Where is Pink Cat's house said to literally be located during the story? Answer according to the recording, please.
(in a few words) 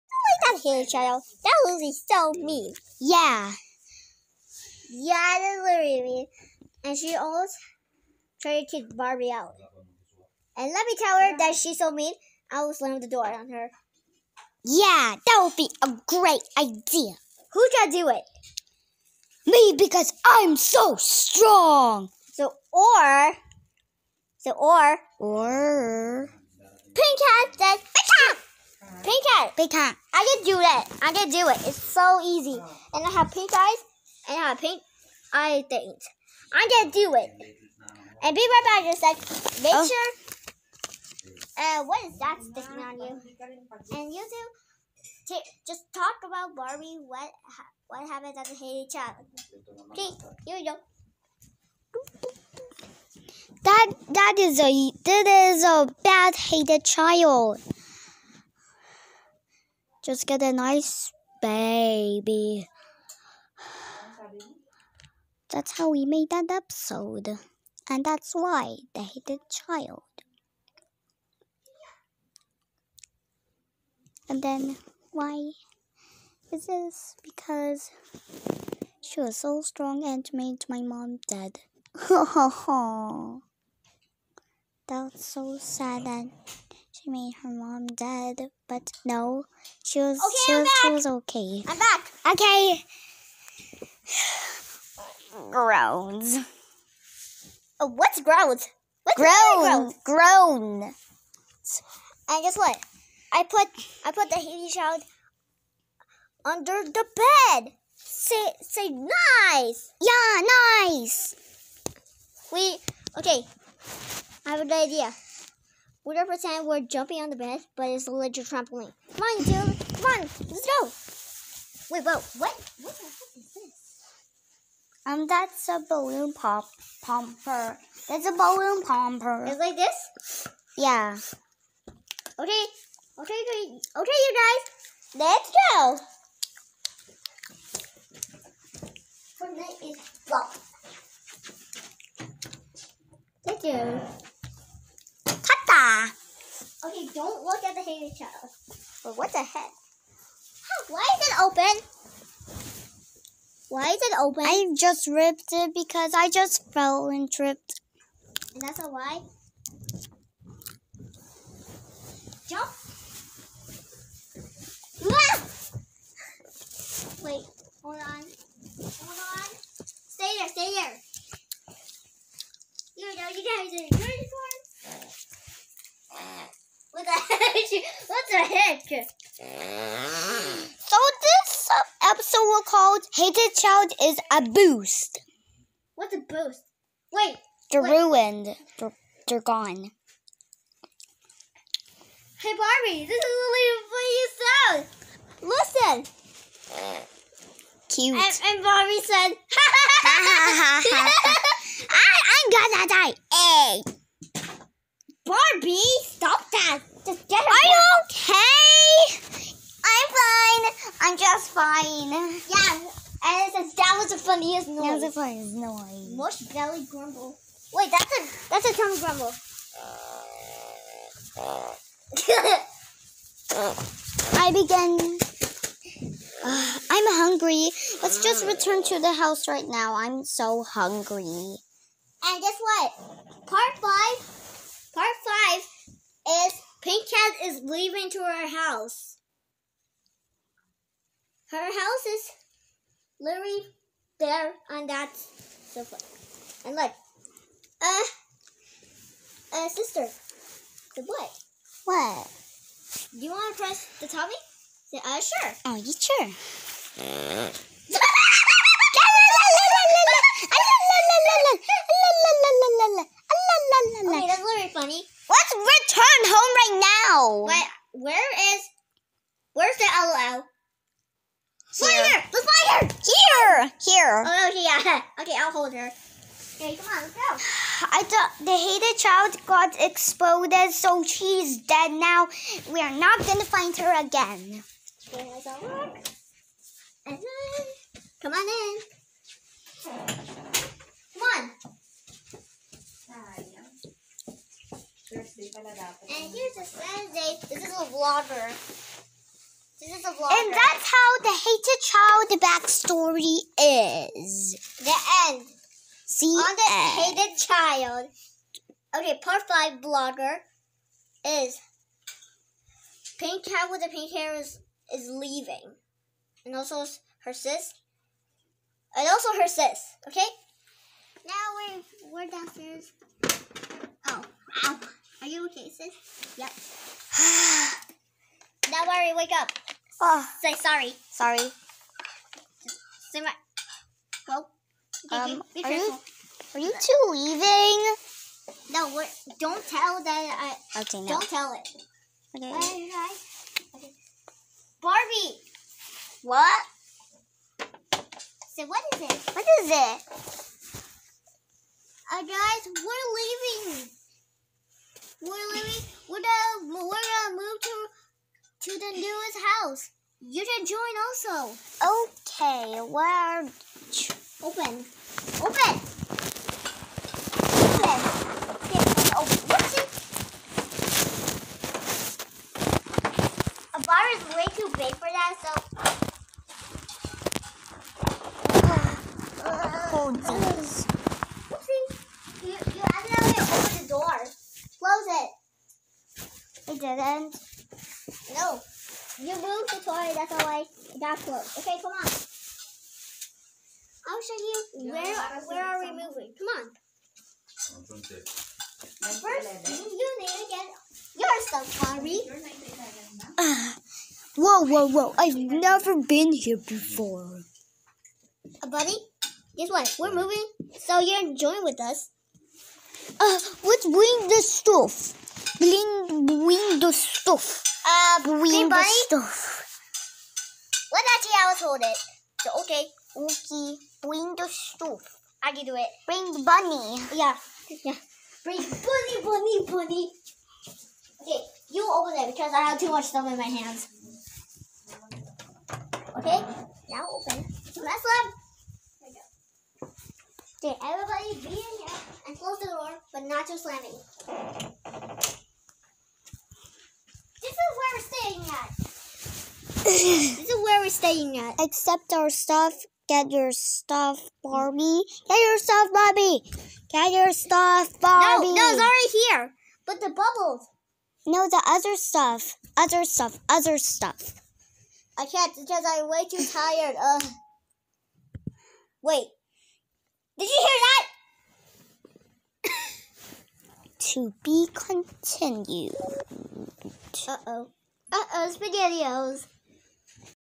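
on that sofa.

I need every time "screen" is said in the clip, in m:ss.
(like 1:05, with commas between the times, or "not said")
not said.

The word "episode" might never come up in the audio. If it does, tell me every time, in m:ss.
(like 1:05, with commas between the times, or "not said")
1:06, 3:02.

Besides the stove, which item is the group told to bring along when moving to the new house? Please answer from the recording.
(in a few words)
the bunny.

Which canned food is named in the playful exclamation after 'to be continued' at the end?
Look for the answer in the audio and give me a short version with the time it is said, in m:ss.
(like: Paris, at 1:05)
SpaghettiOs, at 7:58.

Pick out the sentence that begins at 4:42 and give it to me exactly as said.
We are not gonna find her again.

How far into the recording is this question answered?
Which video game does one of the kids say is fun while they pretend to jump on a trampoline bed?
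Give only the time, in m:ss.
2:19.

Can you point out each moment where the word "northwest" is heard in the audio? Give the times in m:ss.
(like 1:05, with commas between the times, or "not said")
not said.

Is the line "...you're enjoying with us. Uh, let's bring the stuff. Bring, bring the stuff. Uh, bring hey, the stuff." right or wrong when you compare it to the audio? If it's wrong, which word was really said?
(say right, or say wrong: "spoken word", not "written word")
right.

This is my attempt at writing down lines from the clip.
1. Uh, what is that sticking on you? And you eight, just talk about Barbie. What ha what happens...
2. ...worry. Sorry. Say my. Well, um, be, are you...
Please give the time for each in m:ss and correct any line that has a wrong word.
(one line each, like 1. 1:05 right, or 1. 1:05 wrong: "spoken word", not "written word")
1. 0:41 wrong: "two", not "eight"
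2. 5:30 wrong: "sorry", not "worry".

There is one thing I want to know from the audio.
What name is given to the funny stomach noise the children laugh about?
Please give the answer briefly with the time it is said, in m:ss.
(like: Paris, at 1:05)
Mush belly grumble, at 3:36.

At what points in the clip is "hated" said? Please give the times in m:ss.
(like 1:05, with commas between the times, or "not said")
0:00, 0:56, 1:09, 2:27, 3:03, 4:38, 5:01, 5:07.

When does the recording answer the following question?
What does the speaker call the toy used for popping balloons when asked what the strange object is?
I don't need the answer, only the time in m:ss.
2:08.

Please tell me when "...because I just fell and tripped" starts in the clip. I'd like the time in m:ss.
2:35.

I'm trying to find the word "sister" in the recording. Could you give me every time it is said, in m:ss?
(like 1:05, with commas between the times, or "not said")
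4:09.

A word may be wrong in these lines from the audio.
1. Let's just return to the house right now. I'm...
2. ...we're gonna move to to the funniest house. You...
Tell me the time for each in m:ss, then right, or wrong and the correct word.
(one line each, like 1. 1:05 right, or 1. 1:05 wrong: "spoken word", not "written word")
1. 3:48 right
2. 5:56 wrong: "newest", not "funniest".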